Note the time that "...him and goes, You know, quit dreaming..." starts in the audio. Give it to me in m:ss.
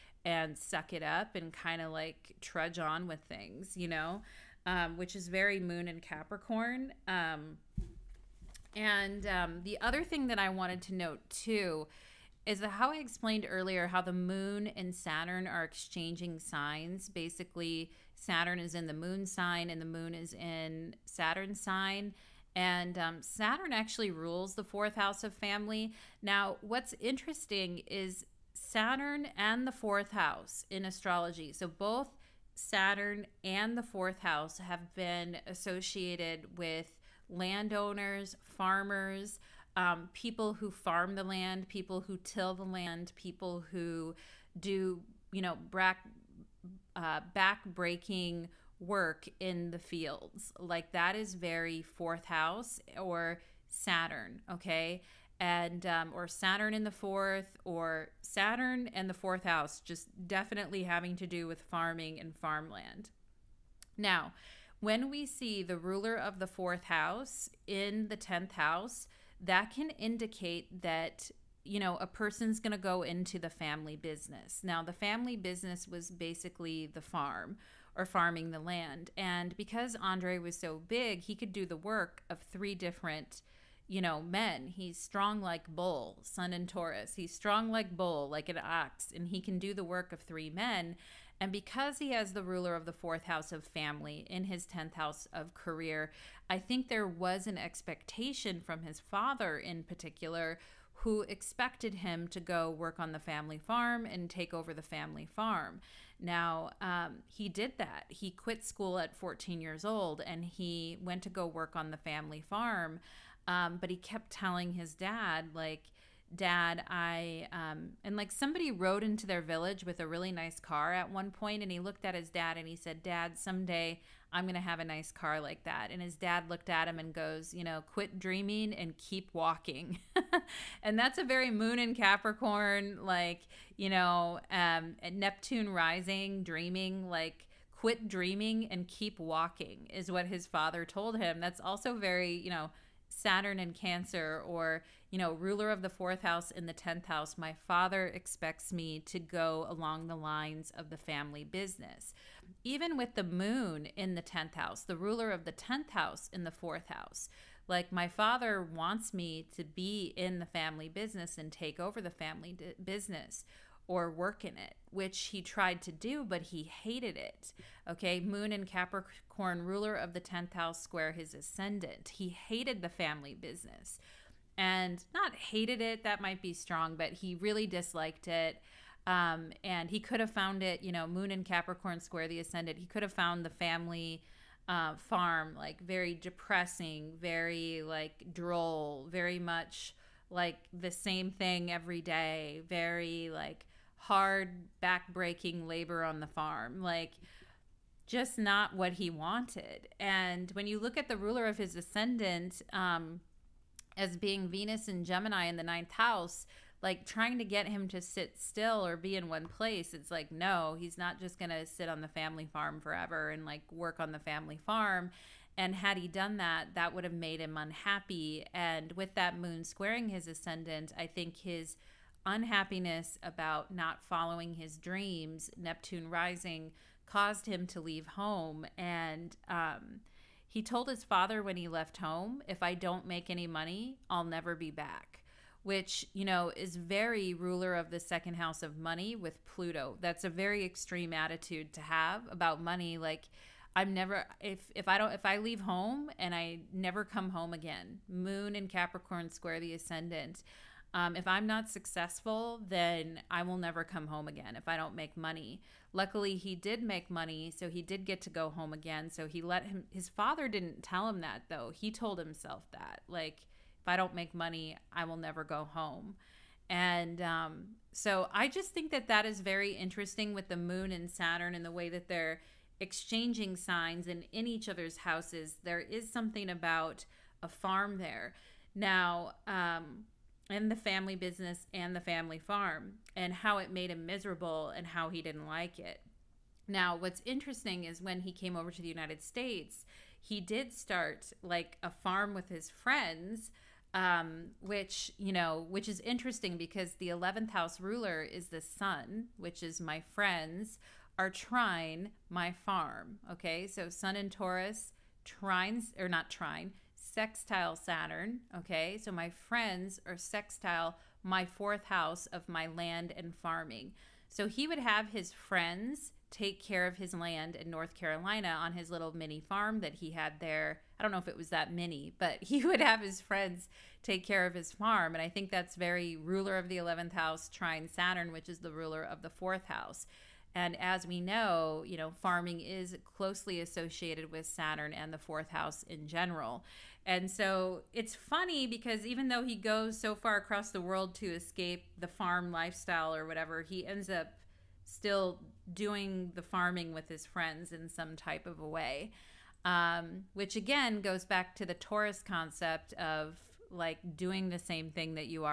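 2:06.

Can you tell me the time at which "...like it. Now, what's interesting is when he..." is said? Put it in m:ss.
4:45.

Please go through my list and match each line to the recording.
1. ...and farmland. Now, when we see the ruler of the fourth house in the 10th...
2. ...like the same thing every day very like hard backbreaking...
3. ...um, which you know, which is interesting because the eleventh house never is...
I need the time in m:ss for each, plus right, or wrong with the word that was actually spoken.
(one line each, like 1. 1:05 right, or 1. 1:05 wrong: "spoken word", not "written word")
1. 1:02 right
2. 3:10 right
3. 4:53 wrong: "ruler", not "never".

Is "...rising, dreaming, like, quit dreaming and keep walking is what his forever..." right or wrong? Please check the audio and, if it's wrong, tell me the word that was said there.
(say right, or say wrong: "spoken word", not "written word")
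wrong: "father", not "forever".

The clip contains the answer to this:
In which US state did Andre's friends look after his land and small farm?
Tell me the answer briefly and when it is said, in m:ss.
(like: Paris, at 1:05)
North Carolina, at 5:17.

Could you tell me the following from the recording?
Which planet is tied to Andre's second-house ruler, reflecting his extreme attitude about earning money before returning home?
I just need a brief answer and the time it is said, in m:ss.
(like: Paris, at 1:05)
Pluto, at 3:59.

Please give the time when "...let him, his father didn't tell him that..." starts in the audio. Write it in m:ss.
4:19.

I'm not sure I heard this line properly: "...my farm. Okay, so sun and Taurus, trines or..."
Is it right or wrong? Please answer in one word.
right.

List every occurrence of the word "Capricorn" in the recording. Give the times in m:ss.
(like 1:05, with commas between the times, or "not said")
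0:06, 2:11, 2:48, 3:01, 4:08.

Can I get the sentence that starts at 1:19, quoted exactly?
And because Andre was so big, he could do the work of three different you know, men.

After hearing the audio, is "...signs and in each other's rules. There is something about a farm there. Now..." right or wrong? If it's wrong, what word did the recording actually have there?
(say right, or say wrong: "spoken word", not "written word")
wrong: "houses", not "rules".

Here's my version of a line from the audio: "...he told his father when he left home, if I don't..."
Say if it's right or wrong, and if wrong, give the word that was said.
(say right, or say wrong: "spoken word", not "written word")
right.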